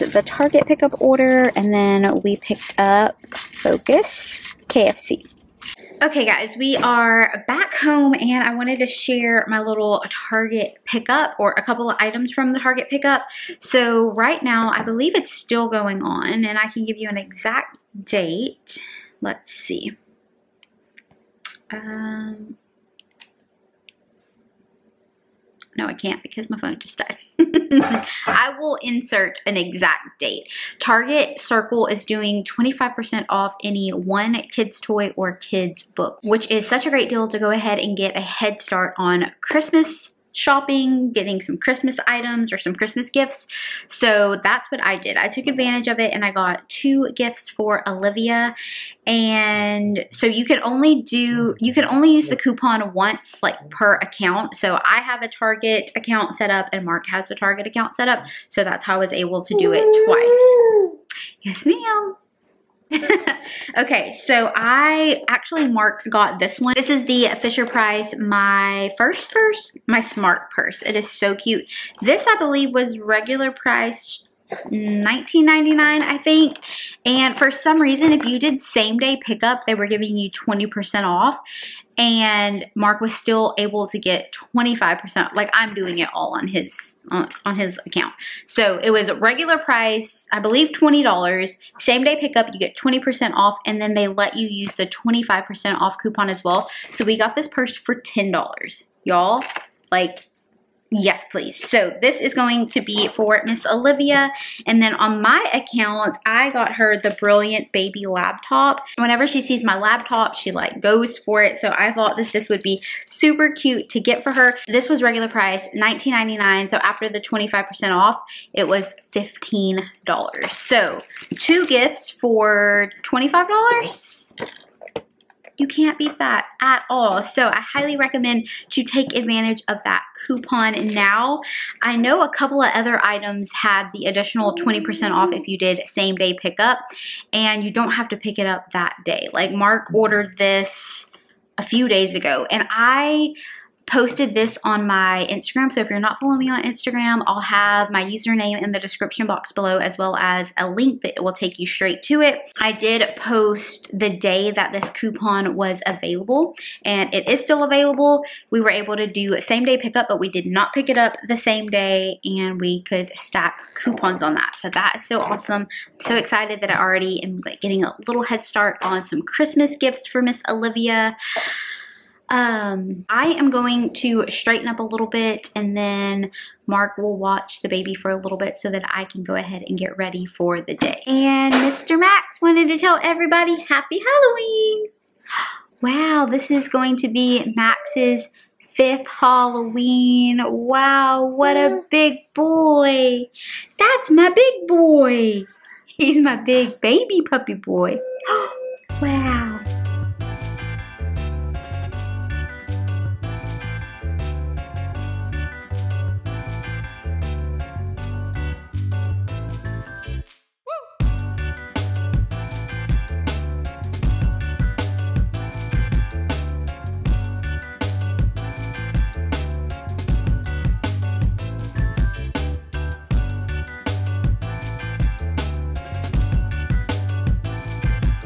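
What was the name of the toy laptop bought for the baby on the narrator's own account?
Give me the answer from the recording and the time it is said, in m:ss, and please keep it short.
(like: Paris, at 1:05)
Brilliant Baby laptop, at 1:47.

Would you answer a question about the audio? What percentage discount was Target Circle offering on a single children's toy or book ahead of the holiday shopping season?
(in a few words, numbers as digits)
25%.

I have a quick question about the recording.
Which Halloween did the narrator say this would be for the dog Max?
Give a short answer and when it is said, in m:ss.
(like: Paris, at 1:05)
Fifth, at 3:08.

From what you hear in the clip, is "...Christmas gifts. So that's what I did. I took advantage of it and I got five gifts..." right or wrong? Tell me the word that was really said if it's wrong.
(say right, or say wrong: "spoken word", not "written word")
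wrong: "two", not "five".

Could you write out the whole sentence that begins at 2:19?
Like Mark ordered this a few days ago and I posted this on my Instagram.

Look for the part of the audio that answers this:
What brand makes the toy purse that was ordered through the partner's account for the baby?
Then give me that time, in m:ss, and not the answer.
1:07.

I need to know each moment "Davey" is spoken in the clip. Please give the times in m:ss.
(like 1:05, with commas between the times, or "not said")
not said.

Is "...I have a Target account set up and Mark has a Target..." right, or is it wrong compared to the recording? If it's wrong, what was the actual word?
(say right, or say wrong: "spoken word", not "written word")
right.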